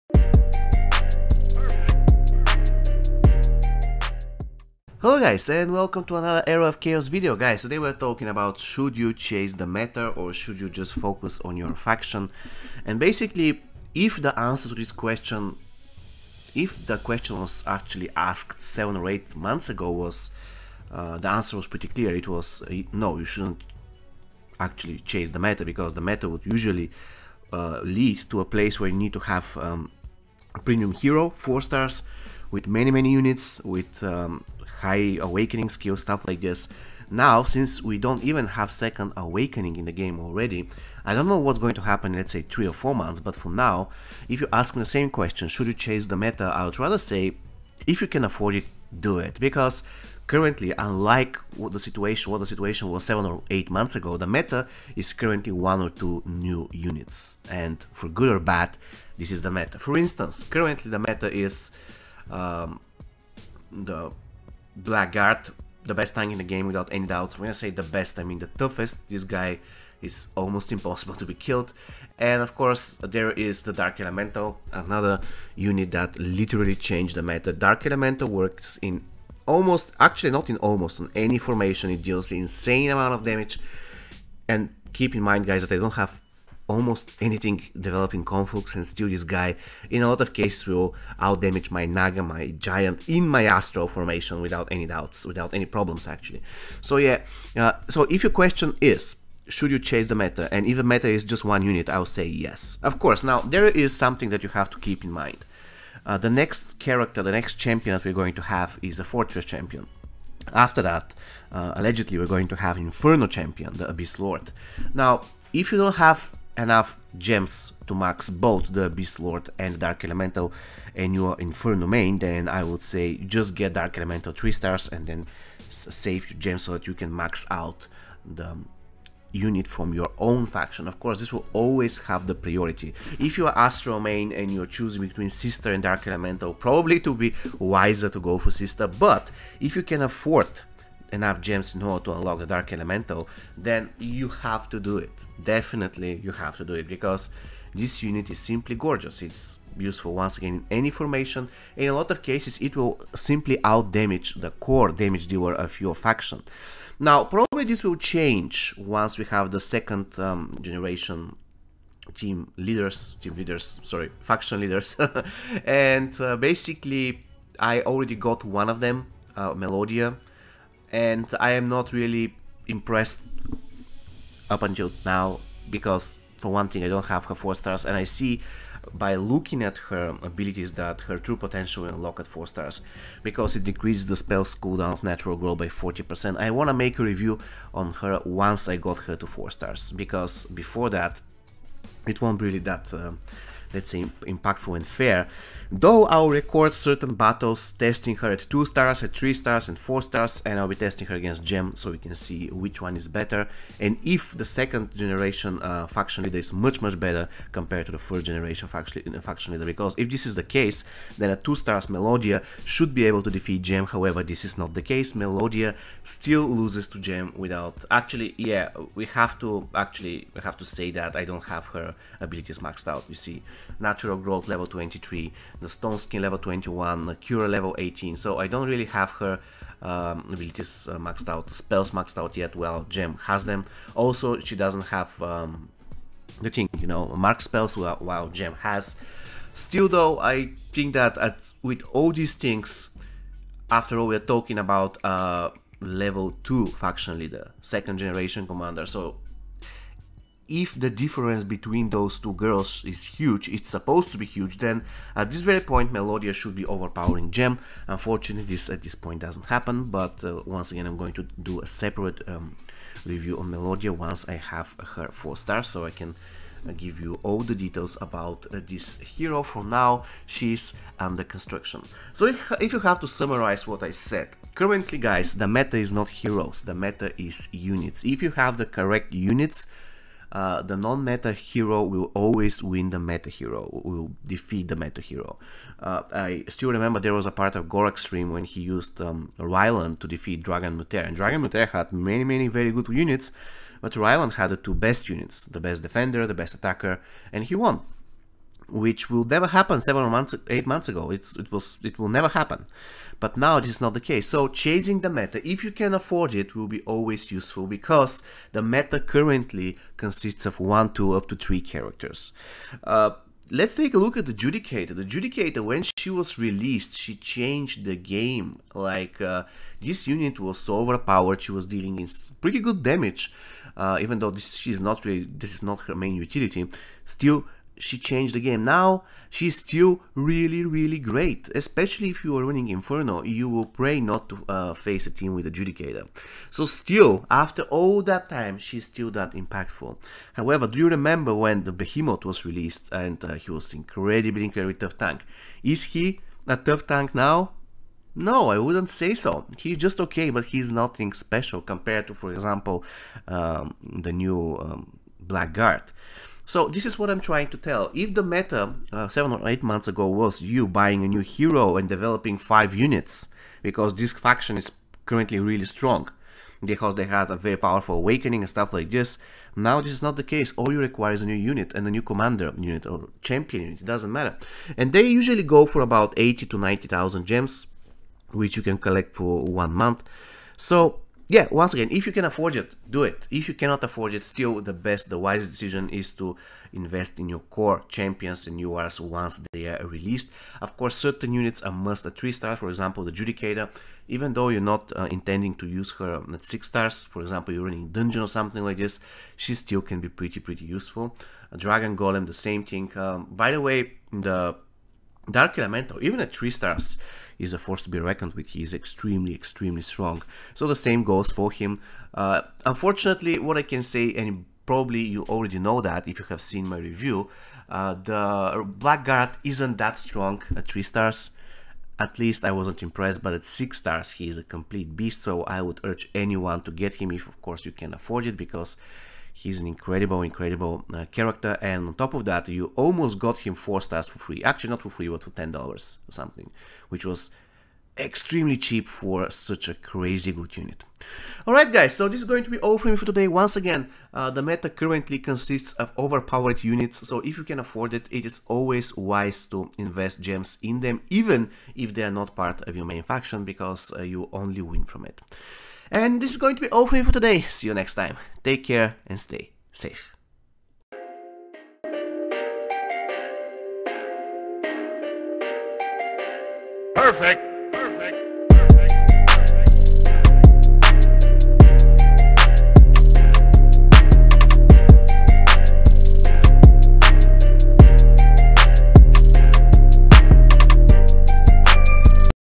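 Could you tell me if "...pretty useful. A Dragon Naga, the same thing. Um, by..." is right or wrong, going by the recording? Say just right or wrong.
wrong.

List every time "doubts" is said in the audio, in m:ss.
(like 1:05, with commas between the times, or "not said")
1:07, 1:34.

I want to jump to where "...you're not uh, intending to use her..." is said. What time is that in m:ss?
6:34.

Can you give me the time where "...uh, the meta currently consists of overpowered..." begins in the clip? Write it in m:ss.
7:24.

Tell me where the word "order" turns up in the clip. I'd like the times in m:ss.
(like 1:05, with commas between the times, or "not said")
2:21.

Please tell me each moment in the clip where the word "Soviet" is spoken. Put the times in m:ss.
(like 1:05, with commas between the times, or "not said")
not said.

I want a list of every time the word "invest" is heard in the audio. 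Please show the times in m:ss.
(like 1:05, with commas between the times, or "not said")
6:26, 7:29.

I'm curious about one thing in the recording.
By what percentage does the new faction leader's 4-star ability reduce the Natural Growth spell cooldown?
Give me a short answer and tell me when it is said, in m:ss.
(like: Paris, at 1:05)
40%, at 3:05.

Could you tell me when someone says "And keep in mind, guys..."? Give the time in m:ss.
1:24.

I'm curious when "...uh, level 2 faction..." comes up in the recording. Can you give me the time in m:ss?
4:05.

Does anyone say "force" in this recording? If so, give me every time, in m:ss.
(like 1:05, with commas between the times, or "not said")
6:47.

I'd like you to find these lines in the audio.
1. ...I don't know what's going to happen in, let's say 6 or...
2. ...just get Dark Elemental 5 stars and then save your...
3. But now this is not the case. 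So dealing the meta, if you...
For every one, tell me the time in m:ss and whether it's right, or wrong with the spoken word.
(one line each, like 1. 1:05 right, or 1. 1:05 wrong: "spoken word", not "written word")
1. 0:41 wrong: "3", not "6"
2. 2:03 wrong: "3", not "5"
3. 5:03 wrong: "chasing", not "dealing".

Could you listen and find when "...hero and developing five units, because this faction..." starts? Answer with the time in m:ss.
6:01.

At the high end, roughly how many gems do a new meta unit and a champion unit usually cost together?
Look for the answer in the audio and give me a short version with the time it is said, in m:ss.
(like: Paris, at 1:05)
90,000, at 6:16.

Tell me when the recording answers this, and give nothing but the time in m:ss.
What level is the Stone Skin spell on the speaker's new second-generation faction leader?
3:45.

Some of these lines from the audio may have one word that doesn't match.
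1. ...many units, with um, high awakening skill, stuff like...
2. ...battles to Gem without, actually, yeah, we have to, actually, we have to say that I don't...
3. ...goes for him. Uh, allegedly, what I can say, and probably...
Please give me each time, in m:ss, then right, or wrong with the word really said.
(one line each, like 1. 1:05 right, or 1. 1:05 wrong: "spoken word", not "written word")
1. 0:32 right
2. 3:36 wrong: "loses", not "battles"
3. 6:51 wrong: "unfortunately", not "allegedly".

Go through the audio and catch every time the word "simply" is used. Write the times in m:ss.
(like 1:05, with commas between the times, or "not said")
2:28, 2:33.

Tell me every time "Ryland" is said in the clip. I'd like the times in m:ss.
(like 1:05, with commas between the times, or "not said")
4:49, 4:53.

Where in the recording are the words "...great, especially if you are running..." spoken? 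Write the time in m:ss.
5:30.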